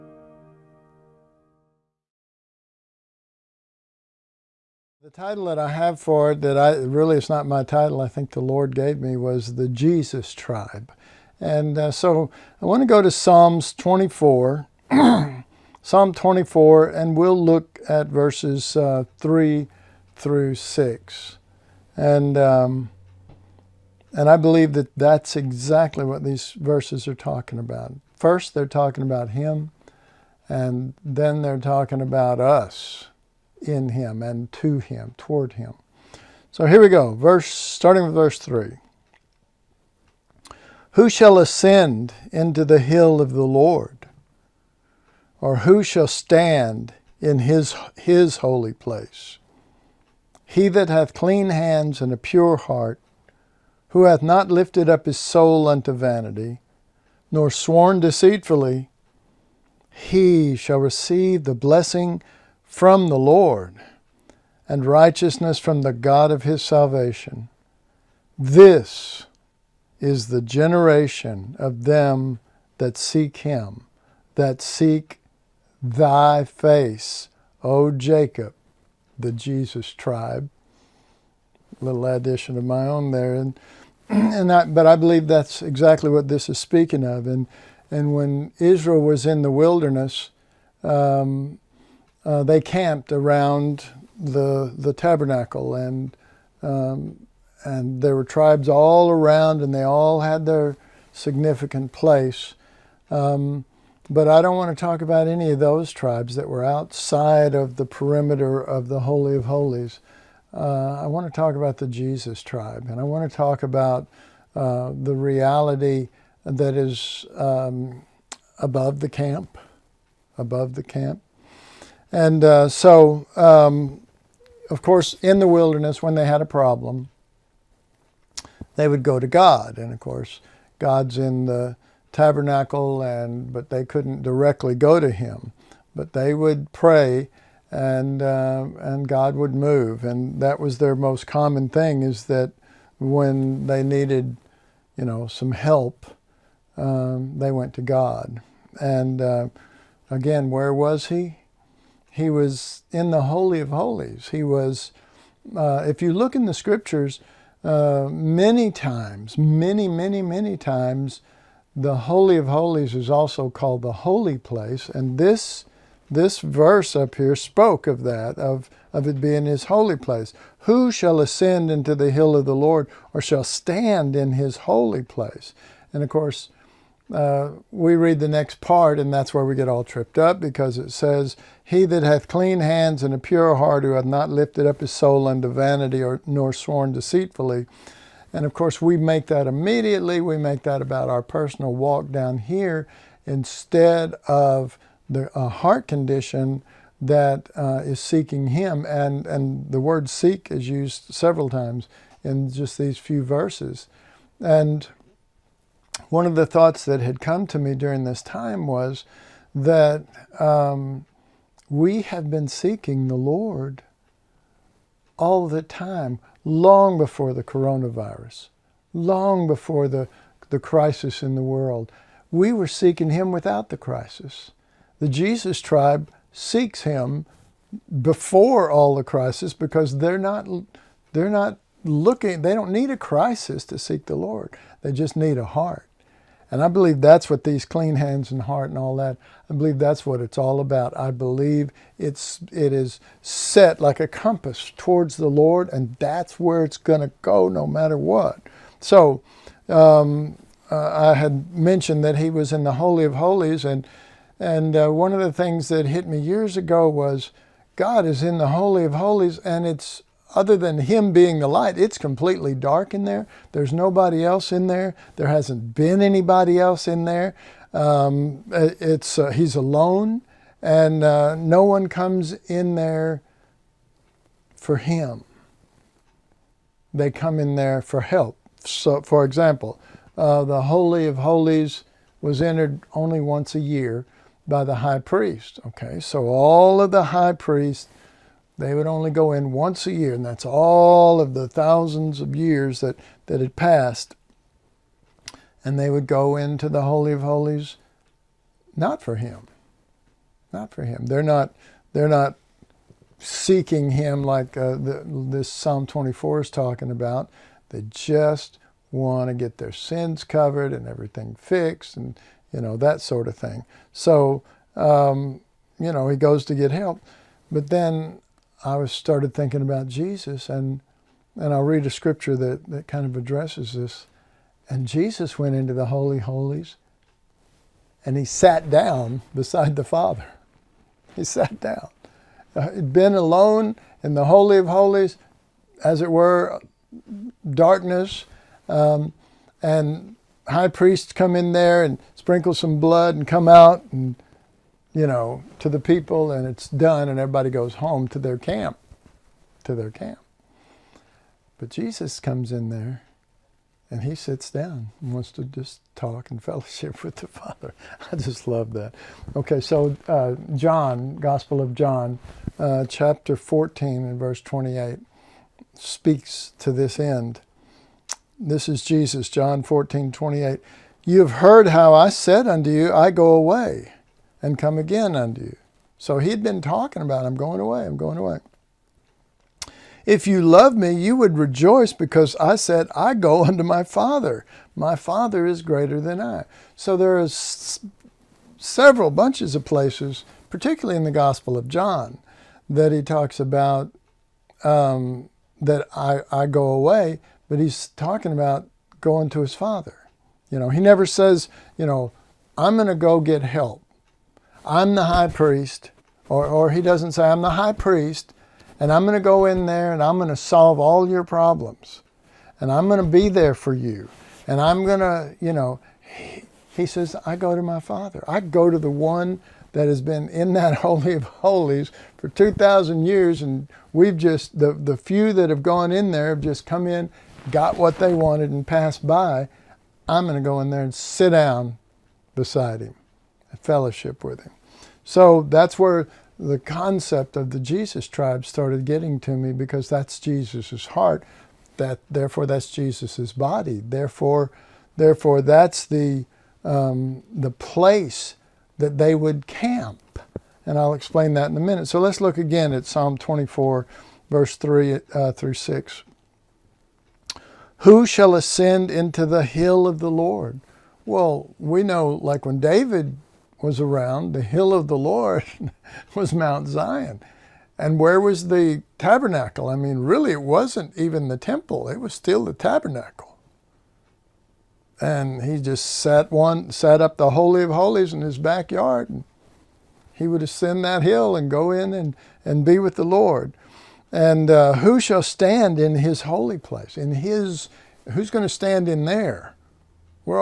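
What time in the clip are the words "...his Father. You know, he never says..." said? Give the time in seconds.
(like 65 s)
399 s.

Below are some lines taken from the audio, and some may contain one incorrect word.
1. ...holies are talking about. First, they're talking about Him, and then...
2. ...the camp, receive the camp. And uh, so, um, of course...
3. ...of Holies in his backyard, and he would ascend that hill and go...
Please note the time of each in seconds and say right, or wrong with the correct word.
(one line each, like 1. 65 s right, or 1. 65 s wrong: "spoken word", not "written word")
1. 26 s wrong: "verses", not "holies"
2. 118 s wrong: "above", not "receive"
3. 477 s right.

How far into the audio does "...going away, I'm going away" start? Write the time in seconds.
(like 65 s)
377 s.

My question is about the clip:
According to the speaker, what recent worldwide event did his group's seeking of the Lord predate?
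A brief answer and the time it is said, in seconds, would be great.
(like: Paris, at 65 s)
The coronavirus, at 217 s.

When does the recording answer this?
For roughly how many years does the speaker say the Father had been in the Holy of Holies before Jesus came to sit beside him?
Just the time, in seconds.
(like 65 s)
422 s.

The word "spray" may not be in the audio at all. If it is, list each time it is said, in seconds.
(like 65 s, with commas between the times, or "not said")
not said.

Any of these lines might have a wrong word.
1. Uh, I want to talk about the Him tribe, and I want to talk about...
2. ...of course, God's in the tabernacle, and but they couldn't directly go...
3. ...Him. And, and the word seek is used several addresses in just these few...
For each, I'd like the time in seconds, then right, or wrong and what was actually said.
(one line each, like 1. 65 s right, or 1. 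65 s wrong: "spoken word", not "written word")
1. 110 s wrong: "Jesus", not "Him"
2. 129 s right
3. 198 s wrong: "times", not "addresses".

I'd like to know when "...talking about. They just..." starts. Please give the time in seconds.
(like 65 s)
306 s.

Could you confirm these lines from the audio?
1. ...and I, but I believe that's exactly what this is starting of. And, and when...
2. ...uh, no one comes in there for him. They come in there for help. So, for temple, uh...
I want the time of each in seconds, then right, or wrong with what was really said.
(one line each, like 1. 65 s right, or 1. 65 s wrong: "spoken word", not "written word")
1. 84 s wrong: "speaking", not "starting"
2. 271 s wrong: "example", not "temple".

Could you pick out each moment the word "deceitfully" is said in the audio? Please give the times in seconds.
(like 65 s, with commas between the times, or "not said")
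58 s, 186 s.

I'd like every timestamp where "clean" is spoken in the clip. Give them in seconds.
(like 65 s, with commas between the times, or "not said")
51 s, 182 s, 237 s.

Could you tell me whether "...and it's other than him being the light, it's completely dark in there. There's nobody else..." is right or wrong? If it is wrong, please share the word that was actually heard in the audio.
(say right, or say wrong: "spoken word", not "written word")
right.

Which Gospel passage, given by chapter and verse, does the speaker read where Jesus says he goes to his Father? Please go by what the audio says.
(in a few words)
John 14:28.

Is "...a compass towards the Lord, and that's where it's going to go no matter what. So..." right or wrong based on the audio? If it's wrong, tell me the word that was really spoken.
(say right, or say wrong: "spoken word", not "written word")
right.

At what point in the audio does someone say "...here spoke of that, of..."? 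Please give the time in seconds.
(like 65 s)
167 s.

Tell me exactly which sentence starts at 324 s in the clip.
And Jesus went into the Holy Holies and he sat down beside the Father.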